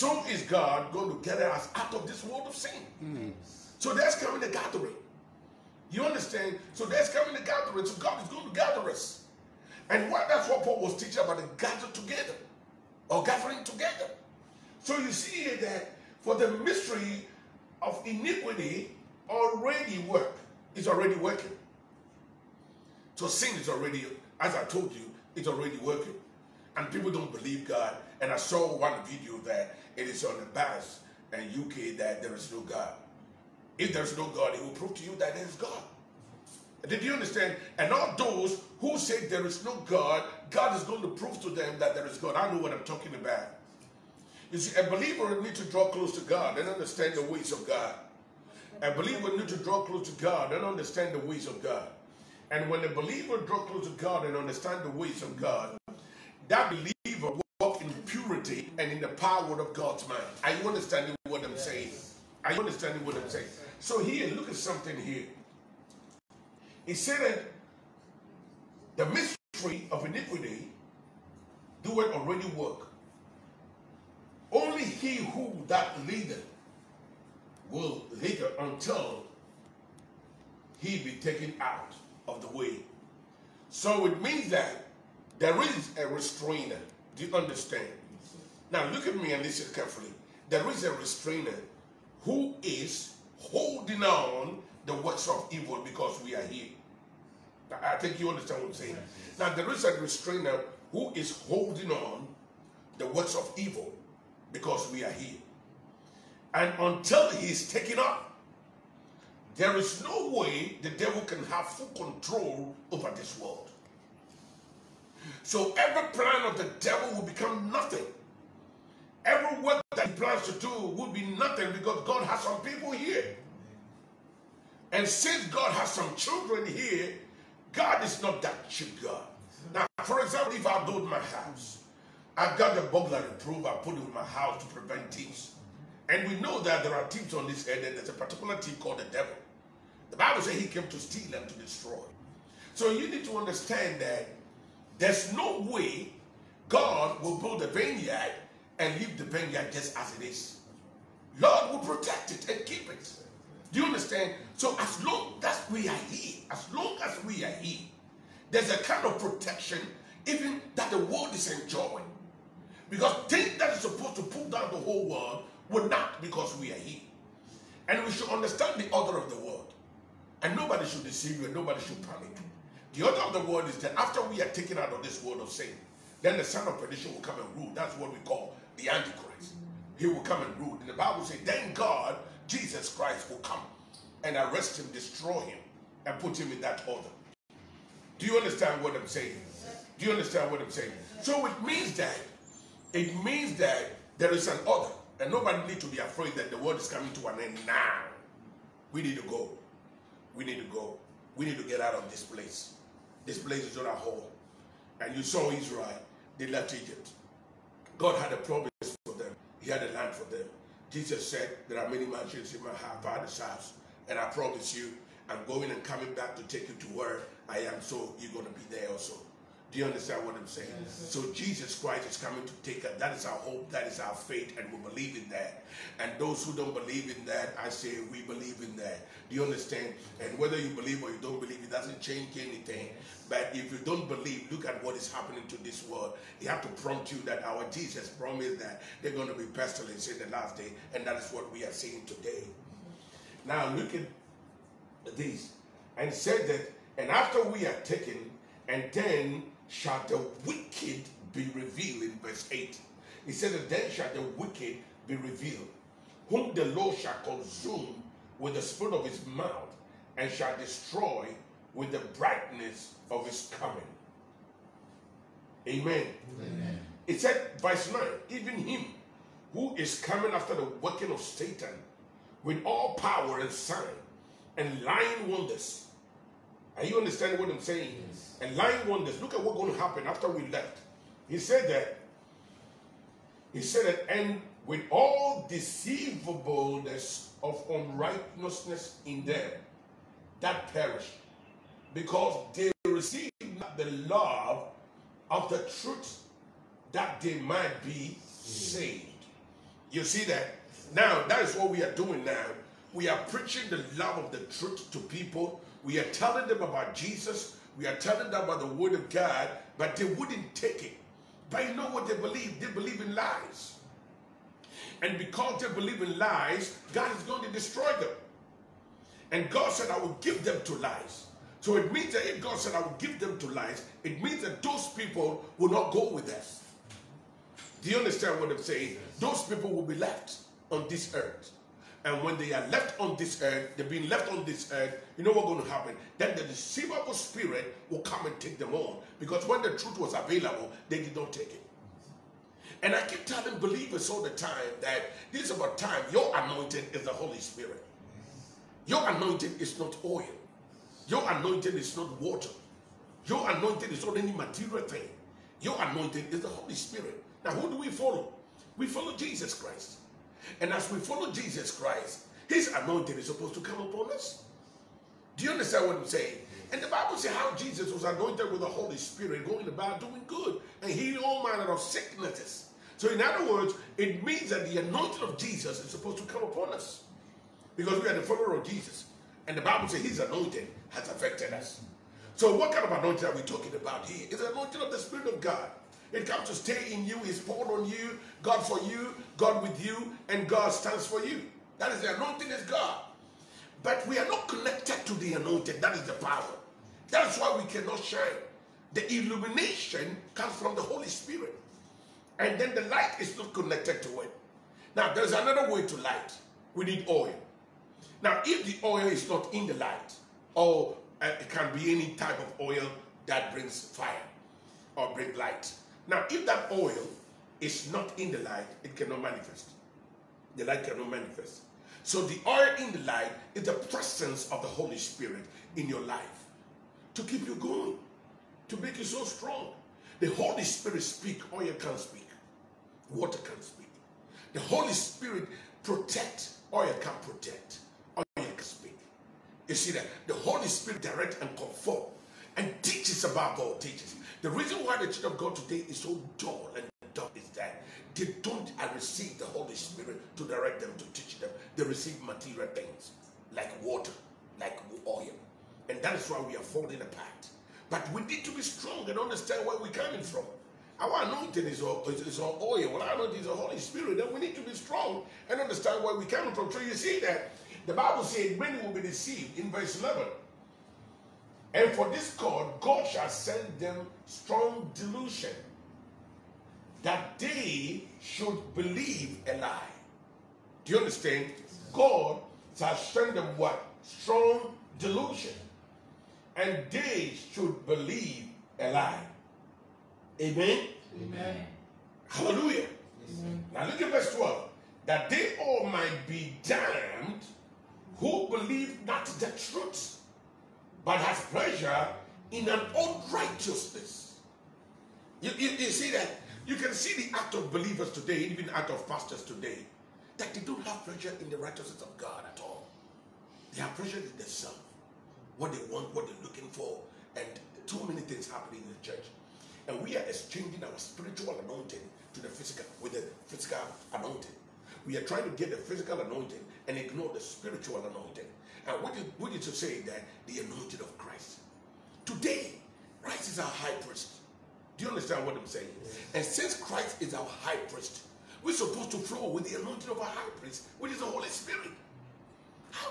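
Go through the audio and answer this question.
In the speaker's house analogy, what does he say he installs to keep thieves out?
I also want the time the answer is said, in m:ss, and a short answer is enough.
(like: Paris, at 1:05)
burglary proof, at 2:12.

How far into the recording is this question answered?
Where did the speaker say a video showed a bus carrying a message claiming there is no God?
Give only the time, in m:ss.
0:31.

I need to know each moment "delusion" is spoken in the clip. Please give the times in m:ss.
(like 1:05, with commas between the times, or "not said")
7:54, 8:04.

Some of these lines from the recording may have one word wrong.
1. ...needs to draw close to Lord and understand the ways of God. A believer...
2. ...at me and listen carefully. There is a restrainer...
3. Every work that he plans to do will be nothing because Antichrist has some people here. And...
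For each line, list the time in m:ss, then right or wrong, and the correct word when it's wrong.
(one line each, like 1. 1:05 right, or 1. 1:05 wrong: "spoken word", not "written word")
1. 0:45 wrong: "God", not "Lord"
2. 1:29 right
3. 1:59 wrong: "God", not "Antichrist".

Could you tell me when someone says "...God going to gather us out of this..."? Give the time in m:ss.
0:00.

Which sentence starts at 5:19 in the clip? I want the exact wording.
And God said, I will give them to lies.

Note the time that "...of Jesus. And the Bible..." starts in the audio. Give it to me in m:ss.
6:18.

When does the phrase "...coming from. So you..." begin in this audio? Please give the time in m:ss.
7:46.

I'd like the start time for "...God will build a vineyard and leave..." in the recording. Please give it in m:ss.
2:26.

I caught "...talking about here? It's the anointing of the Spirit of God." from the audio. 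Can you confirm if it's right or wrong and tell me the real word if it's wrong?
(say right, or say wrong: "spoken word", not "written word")
right.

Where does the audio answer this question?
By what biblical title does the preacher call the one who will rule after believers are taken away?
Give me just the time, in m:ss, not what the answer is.
2:56.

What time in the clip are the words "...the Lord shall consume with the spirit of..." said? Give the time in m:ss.
4:16.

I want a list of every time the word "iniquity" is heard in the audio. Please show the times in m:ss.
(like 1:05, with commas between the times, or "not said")
0:18, 1:10.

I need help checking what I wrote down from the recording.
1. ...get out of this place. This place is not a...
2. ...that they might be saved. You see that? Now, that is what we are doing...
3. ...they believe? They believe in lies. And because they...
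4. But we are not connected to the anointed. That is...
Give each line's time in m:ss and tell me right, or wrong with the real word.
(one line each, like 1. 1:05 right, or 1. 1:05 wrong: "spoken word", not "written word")
1. 3:21 right
2. 4:56 right
3. 5:12 right
4. 6:33 right.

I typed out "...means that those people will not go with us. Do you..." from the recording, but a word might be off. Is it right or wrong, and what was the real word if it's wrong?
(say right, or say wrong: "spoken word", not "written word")
right.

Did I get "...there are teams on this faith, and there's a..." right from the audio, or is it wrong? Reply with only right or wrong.
wrong.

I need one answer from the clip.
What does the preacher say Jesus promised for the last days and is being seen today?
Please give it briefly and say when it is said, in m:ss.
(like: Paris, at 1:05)
pestilence, at 3:59.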